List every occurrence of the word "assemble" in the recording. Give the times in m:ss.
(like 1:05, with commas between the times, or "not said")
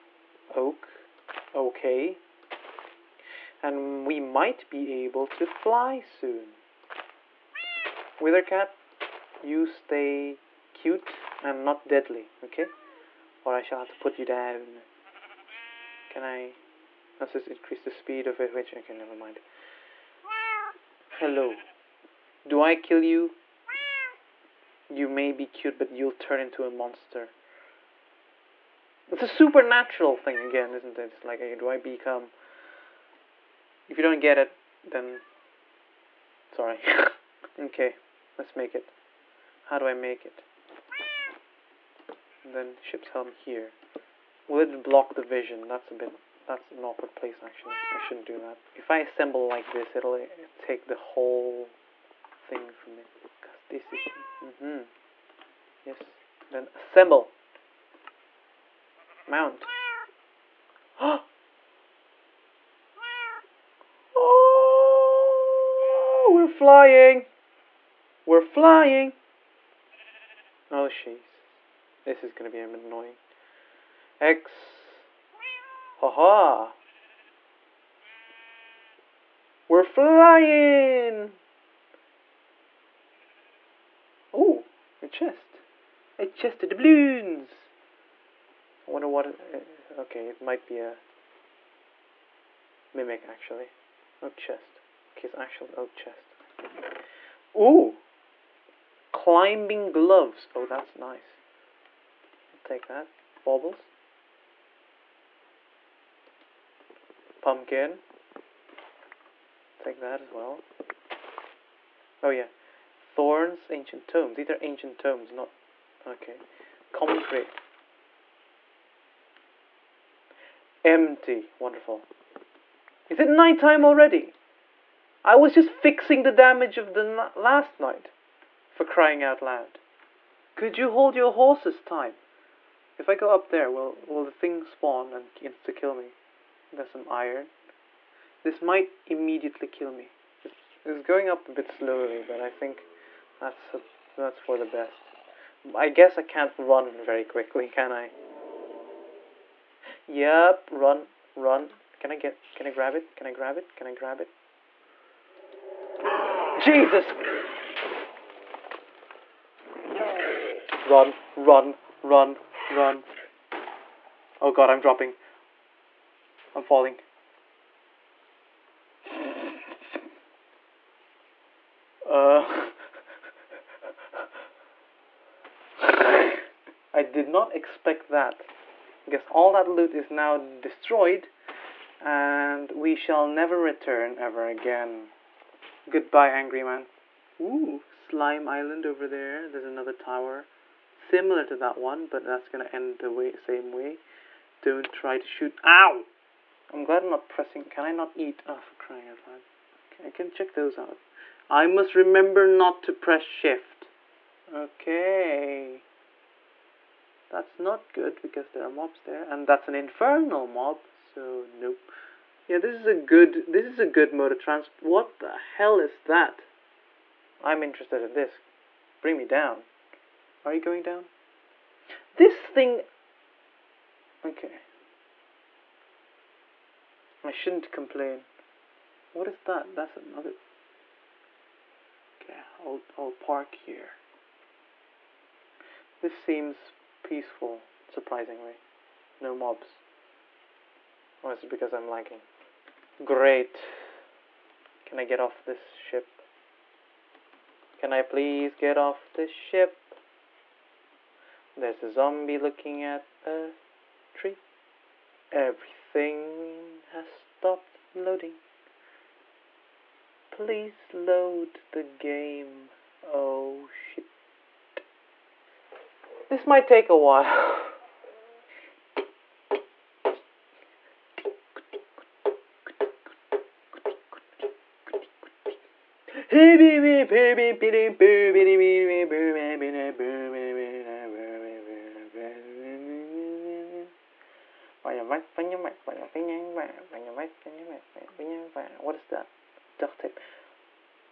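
0:48, 0:56.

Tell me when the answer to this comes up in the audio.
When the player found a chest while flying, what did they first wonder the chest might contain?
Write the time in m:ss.
1:26.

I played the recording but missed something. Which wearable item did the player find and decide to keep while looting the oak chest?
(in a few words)
Climbing gloves.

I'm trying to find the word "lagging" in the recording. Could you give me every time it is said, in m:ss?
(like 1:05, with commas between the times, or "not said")
4:01.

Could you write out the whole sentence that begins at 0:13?
Or I shall have to put you down.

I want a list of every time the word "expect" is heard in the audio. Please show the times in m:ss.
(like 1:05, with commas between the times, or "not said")
2:57.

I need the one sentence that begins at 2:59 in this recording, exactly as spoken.
I guess all that loot is now destroyed and we shall never return ever again.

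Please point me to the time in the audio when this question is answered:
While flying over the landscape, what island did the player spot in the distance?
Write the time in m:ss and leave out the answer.
3:07.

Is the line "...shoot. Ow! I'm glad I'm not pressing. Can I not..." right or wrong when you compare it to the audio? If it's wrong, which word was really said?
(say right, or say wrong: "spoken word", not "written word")
right.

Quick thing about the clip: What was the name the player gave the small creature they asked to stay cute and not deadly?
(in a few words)
Withercat.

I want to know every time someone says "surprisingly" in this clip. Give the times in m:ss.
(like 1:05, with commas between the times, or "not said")
3:57.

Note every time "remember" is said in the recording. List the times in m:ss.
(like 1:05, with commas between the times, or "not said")
3:21.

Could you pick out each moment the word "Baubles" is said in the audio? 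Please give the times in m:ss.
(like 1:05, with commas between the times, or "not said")
1:43.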